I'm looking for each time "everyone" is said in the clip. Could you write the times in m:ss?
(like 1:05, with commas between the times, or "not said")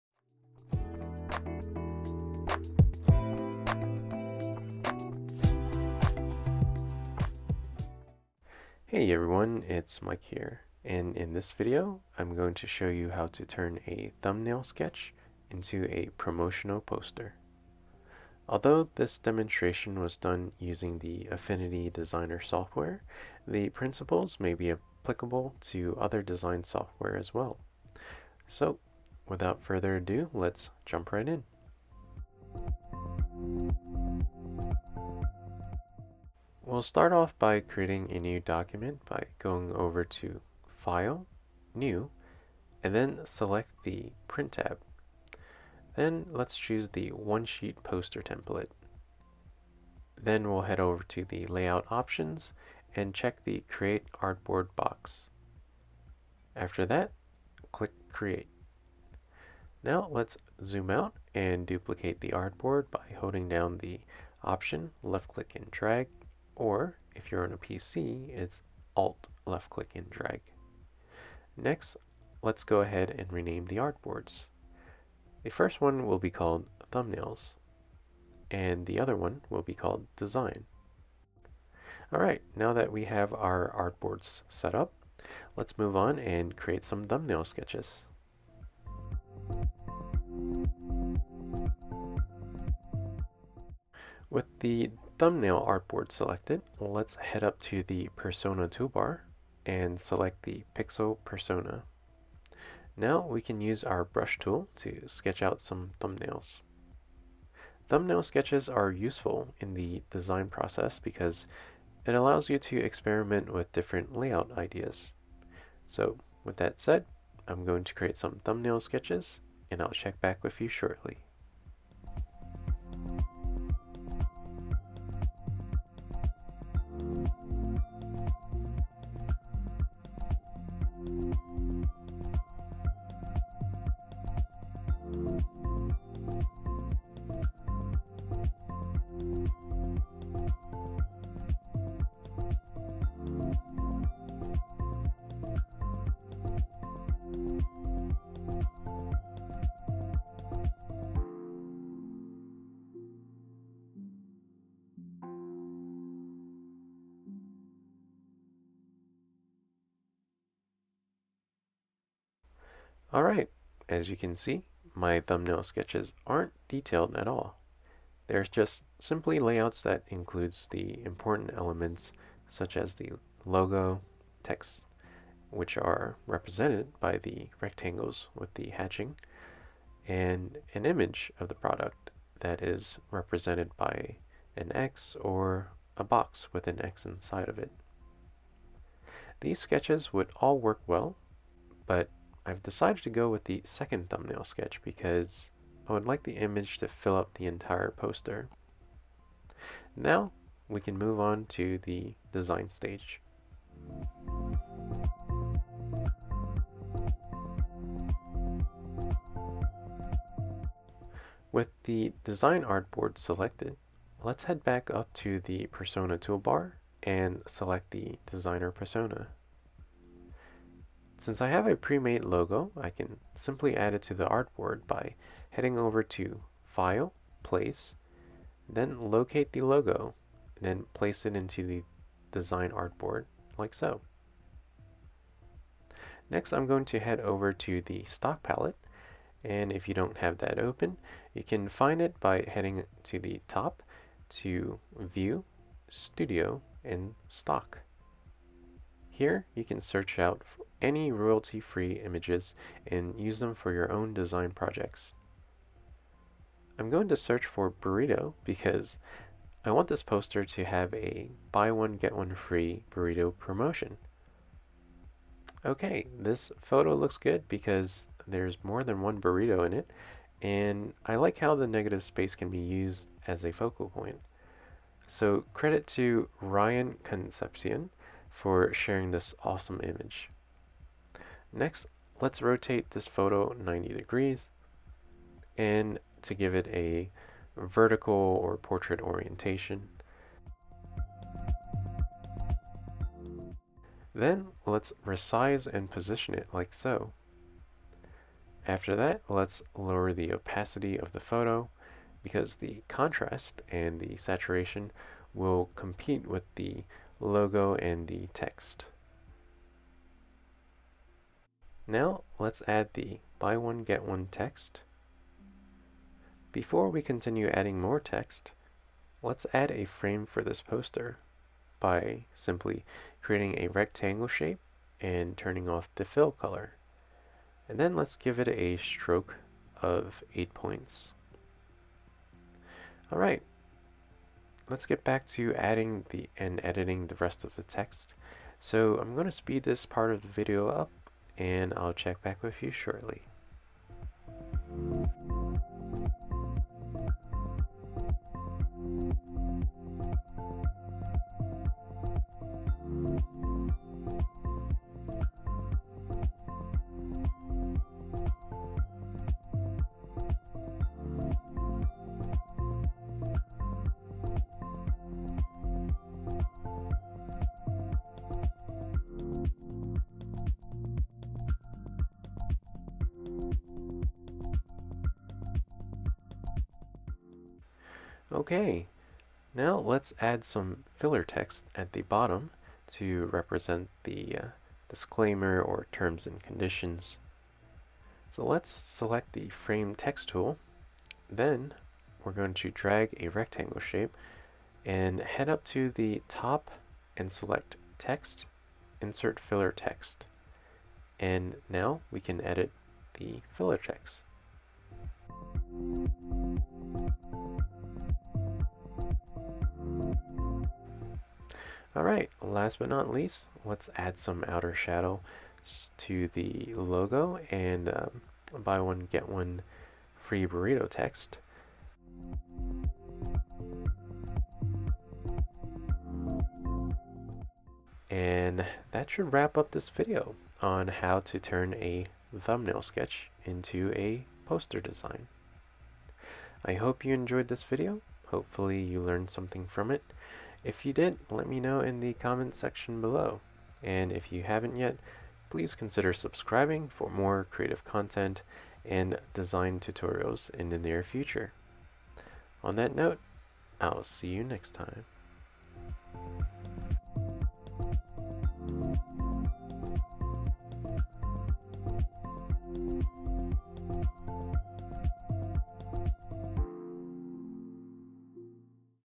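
0:09.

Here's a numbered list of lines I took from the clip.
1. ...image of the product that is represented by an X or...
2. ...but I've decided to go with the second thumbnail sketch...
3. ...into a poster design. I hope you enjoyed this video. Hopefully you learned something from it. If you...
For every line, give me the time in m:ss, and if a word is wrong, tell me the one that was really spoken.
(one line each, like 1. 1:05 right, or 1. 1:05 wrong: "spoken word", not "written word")
1. 3:00 right
2. 3:11 right
3. 7:13 right.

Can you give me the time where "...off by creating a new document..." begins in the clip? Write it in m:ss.
0:37.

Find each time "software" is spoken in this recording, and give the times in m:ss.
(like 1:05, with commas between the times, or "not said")
0:22, 0:26.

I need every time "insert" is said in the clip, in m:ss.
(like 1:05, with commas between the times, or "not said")
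6:39.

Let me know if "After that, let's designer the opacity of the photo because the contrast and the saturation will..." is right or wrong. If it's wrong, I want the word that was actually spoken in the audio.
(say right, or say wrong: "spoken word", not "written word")
wrong: "lower", not "designer".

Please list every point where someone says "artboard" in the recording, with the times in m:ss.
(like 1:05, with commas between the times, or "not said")
0:54, 1:02, 1:13, 1:23, 1:35, 3:32, 3:44, 3:52.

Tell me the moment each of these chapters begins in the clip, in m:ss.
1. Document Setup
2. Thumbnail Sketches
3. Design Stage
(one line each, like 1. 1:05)
1. 0:30
2. 1:30
3. 3:25.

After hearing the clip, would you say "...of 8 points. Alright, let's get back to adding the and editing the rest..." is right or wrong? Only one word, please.
right.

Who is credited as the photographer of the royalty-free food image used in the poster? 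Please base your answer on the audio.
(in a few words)
Ryan Concepcion.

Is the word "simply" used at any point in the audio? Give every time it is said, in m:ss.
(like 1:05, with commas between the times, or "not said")
2:48, 3:43, 5:22.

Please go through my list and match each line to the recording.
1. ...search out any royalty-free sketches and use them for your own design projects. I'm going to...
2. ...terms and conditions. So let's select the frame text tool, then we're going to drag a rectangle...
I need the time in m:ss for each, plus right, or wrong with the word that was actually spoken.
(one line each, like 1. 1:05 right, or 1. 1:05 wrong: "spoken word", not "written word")
1. 4:09 wrong: "images", not "sketches"
2. 6:25 right.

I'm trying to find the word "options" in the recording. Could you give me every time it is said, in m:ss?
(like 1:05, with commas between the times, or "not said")
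0:51, 1:04.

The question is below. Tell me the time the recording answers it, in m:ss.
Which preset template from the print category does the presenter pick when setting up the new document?
0:47.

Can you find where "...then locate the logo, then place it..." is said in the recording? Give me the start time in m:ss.
3:48.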